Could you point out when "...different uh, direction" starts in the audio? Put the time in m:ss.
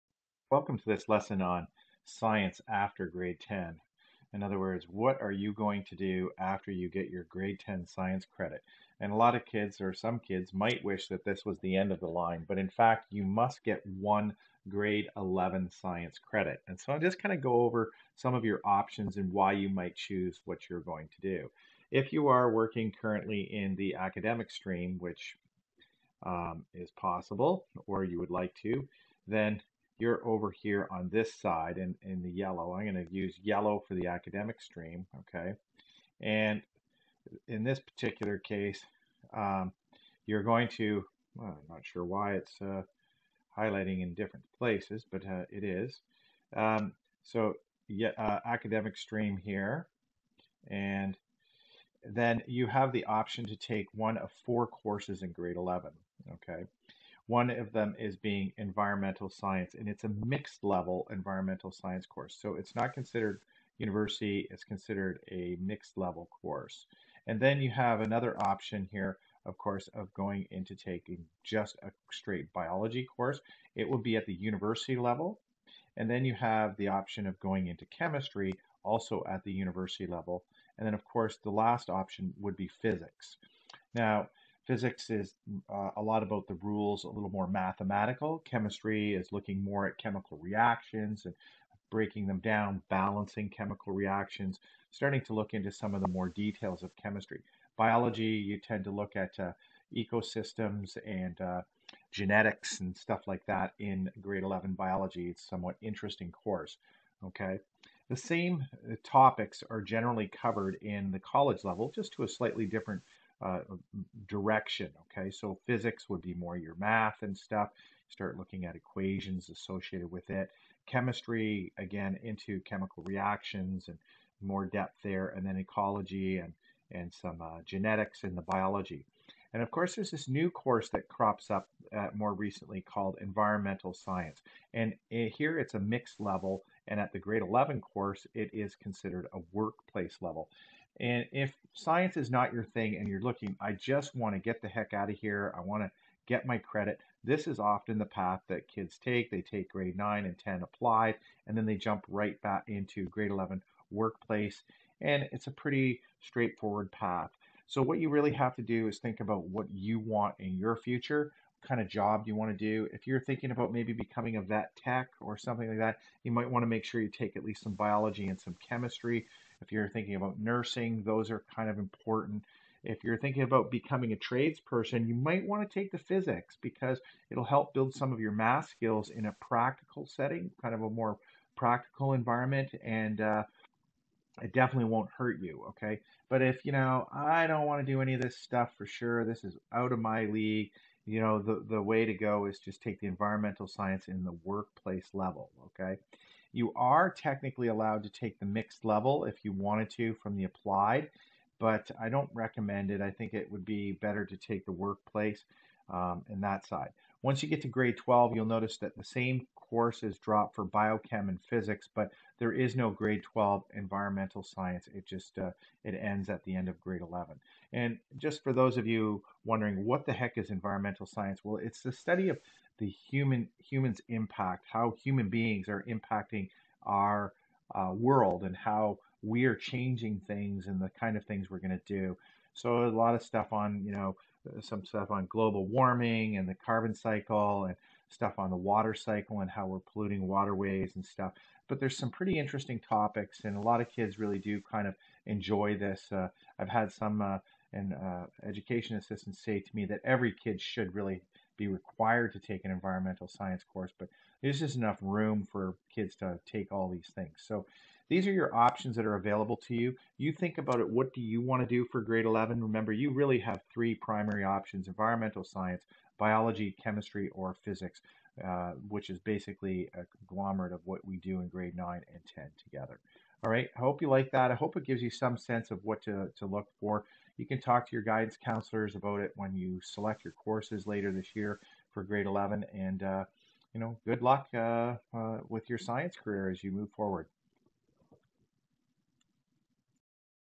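1:52.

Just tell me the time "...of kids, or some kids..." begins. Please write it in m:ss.
0:09.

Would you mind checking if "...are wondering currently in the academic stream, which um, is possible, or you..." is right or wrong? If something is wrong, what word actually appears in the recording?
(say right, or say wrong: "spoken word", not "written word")
wrong: "working", not "wondering".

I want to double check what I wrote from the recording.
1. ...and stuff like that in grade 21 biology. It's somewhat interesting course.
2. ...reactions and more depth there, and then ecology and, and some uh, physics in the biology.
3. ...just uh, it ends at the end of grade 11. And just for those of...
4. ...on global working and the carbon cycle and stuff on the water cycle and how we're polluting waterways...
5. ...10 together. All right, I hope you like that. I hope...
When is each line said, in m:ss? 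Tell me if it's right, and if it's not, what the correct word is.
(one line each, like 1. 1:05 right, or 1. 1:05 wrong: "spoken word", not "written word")
1. 1:42 wrong: "11", not "21"
2. 2:03 wrong: "genetics", not "physics"
3. 3:35 right
4. 3:55 wrong: "warming", not "working"
5. 4:32 right.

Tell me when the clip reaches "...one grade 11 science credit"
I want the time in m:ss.
0:13.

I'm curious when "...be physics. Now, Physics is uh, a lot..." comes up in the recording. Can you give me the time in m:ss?
1:22.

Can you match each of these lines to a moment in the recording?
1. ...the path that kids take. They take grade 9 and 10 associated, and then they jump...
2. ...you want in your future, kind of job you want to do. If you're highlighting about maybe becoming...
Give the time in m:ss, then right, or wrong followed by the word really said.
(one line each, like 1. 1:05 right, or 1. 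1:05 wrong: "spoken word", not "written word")
1. 2:27 wrong: "applied", not "associated"
2. 2:39 wrong: "thinking", not "highlighting".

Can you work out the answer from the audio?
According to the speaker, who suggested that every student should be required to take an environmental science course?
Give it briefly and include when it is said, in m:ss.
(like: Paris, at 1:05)
Education assistants, at 4:08.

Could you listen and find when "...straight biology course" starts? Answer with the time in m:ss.
1:12.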